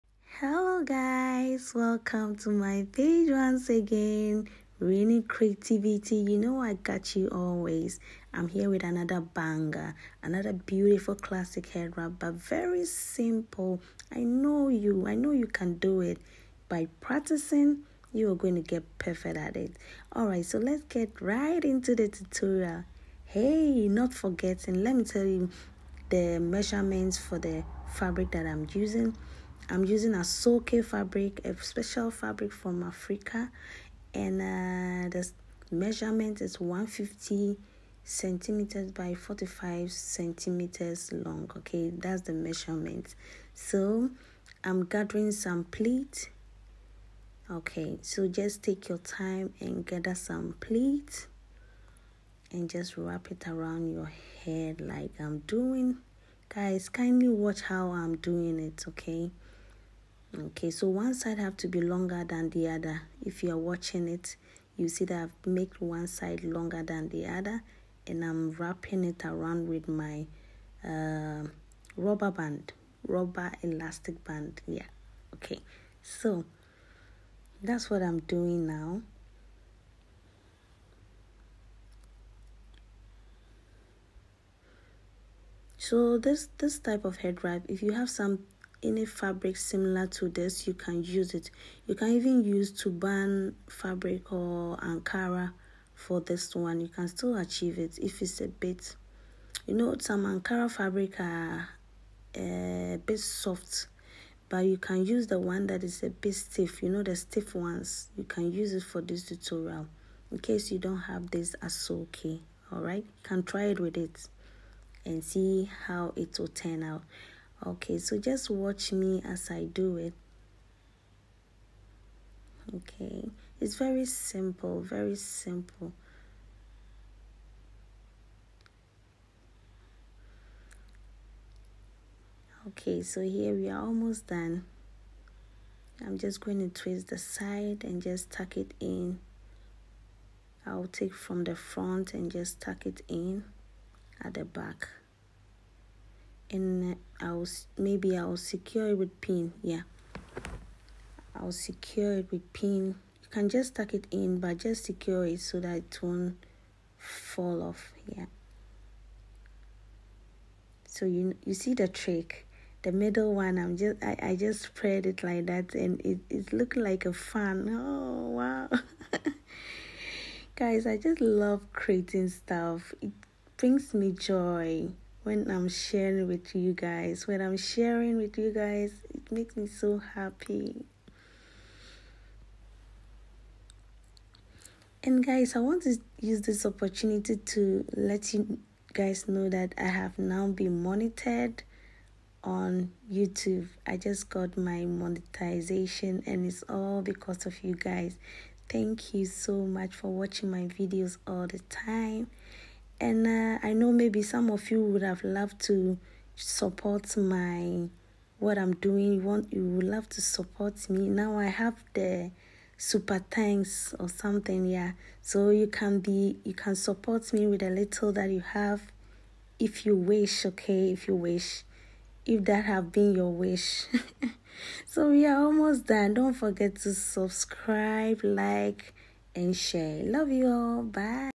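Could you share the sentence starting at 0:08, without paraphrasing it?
I'm here with another banger, another beautiful classic head wrap, but very simple.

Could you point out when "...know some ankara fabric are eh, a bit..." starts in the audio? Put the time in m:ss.
1:39.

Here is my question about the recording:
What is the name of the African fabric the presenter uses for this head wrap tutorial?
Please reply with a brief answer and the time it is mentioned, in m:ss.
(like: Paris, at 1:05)
Asooke, at 0:30.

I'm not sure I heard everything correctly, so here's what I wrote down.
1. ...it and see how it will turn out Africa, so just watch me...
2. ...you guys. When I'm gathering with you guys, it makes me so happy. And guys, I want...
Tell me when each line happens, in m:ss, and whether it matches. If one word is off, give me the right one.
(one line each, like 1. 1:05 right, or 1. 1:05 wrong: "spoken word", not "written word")
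1. 1:53 wrong: "Okay", not "Africa"
2. 2:56 wrong: "sharing", not "gathering".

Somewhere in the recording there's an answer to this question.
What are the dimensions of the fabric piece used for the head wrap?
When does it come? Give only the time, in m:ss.
0:36.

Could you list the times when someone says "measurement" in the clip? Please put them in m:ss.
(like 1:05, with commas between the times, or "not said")
0:26, 0:35, 0:42.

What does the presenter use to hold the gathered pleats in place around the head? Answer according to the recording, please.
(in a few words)
rubber elastic band.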